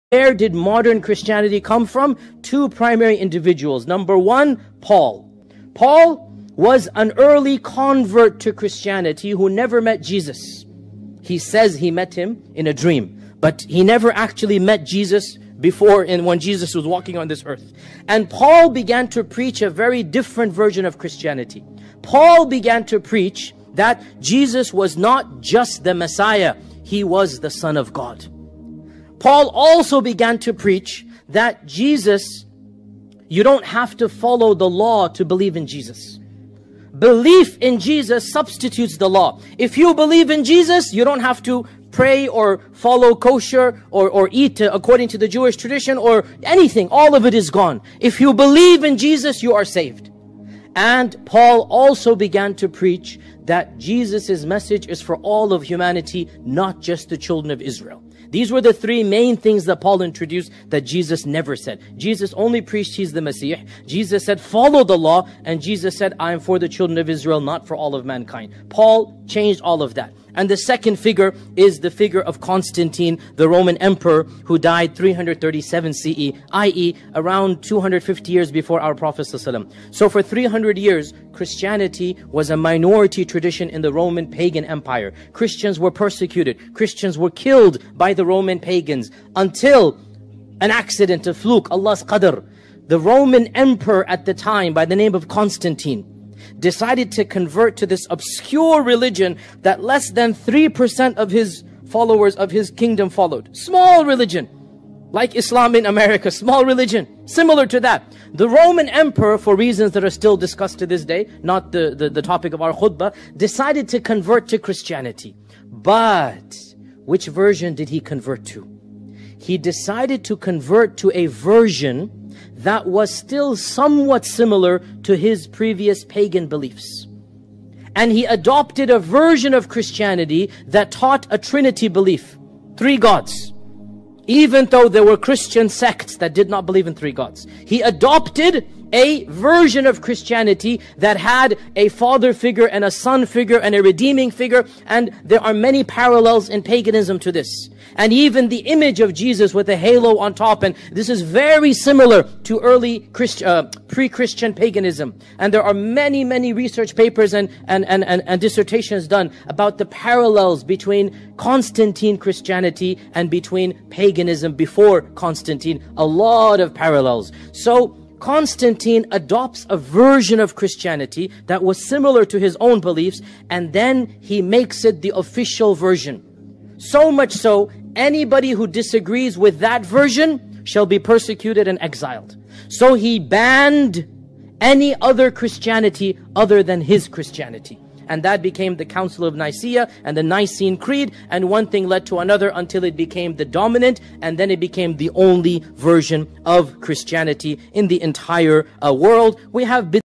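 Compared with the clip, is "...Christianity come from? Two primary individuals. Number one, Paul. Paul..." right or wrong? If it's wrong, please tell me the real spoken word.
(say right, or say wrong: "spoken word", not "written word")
right.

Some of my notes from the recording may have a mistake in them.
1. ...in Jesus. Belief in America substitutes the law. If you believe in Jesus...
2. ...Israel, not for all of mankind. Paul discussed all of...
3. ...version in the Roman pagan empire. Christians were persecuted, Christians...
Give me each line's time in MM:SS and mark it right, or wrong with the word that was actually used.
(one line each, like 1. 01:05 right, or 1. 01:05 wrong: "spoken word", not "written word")
1. 00:35 wrong: "Jesus", not "America"
2. 01:07 wrong: "changed", not "discussed"
3. 01:23 wrong: "tradition", not "version".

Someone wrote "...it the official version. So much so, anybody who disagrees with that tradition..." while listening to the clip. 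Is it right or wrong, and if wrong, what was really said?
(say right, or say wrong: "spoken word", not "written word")
wrong: "version", not "tradition".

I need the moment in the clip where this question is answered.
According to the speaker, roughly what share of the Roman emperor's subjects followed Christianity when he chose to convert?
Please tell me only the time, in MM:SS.
01:39.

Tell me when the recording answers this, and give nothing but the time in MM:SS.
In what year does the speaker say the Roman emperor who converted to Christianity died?
01:14.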